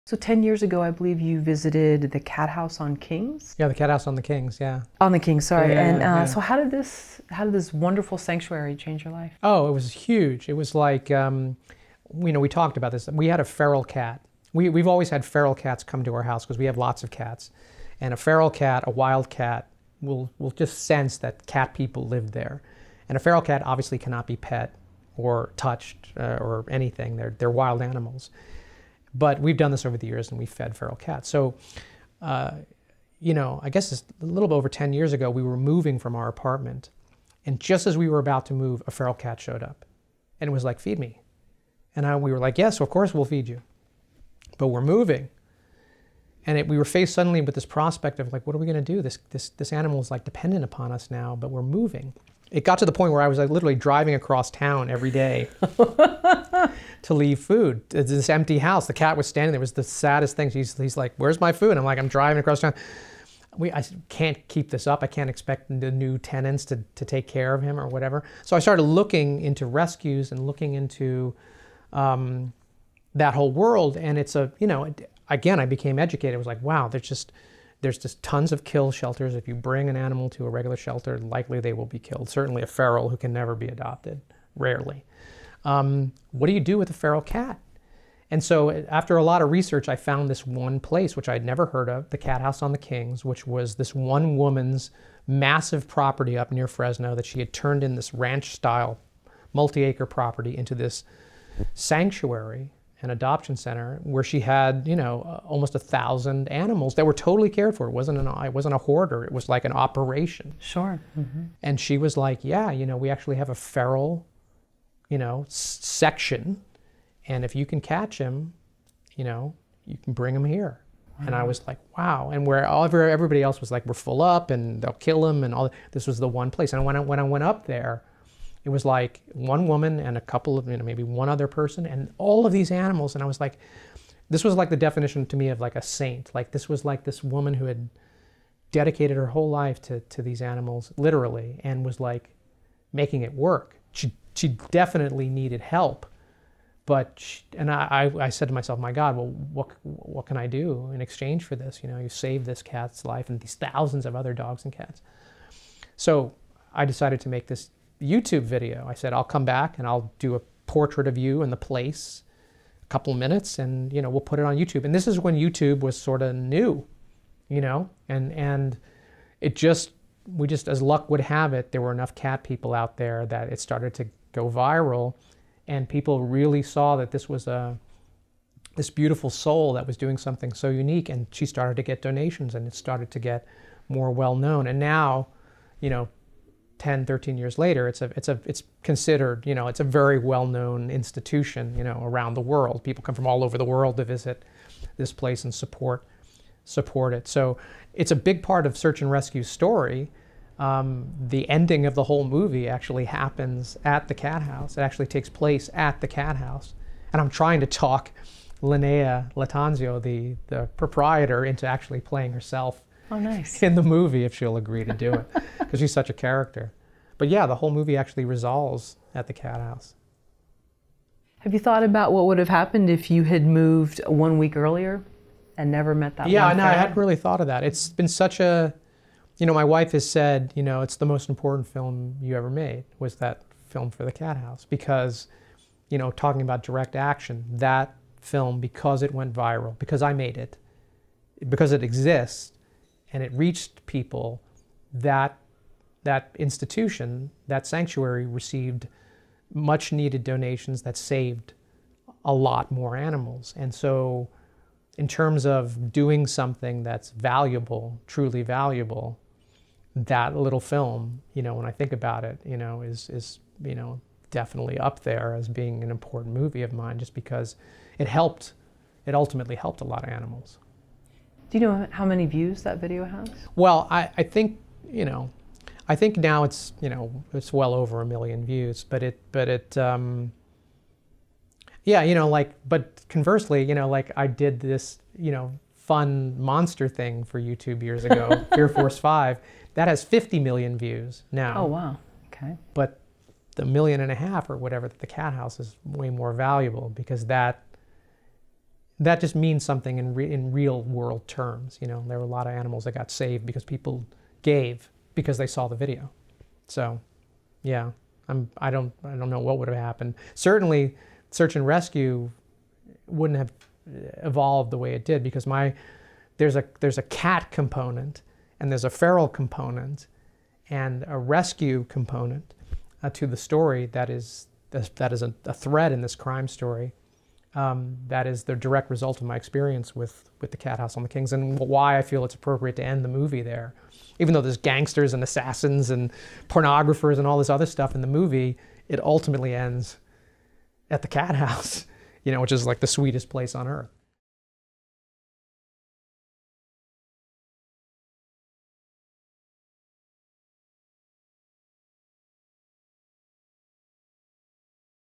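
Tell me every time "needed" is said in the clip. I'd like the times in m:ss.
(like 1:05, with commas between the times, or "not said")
2:25, 4:09.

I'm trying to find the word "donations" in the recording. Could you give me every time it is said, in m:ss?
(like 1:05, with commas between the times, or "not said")
3:02, 4:10.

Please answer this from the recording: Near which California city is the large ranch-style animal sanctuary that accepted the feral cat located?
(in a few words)
Fresno.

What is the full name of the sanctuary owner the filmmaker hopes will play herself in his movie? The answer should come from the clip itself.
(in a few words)
Lynea Lattanzio.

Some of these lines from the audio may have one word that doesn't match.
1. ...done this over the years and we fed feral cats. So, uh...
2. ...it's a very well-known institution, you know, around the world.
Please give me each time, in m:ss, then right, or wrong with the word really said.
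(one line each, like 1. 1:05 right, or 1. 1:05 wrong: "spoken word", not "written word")
1. 0:29 right
2. 3:09 right.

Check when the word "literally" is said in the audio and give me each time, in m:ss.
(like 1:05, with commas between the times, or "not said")
0:53, 2:20.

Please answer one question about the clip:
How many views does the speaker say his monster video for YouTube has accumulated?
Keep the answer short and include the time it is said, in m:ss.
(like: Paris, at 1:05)
50 million, at 4:50.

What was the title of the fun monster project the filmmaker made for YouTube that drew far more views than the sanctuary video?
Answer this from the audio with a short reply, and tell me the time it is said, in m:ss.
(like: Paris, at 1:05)
Fear Force 5, at 4:48.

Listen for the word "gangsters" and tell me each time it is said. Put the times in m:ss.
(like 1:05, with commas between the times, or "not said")
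5:34.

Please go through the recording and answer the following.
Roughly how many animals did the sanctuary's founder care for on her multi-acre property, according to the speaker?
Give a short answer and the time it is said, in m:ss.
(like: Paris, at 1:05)
almost 1,000, at 1:45.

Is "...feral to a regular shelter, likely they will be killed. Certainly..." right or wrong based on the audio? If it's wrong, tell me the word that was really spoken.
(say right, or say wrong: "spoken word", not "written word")
wrong: "animal", not "feral".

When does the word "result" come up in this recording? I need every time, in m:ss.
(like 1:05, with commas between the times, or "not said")
5:28.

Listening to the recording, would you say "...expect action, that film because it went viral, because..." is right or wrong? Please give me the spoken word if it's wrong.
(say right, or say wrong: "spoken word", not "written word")
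wrong: "direct", not "expect".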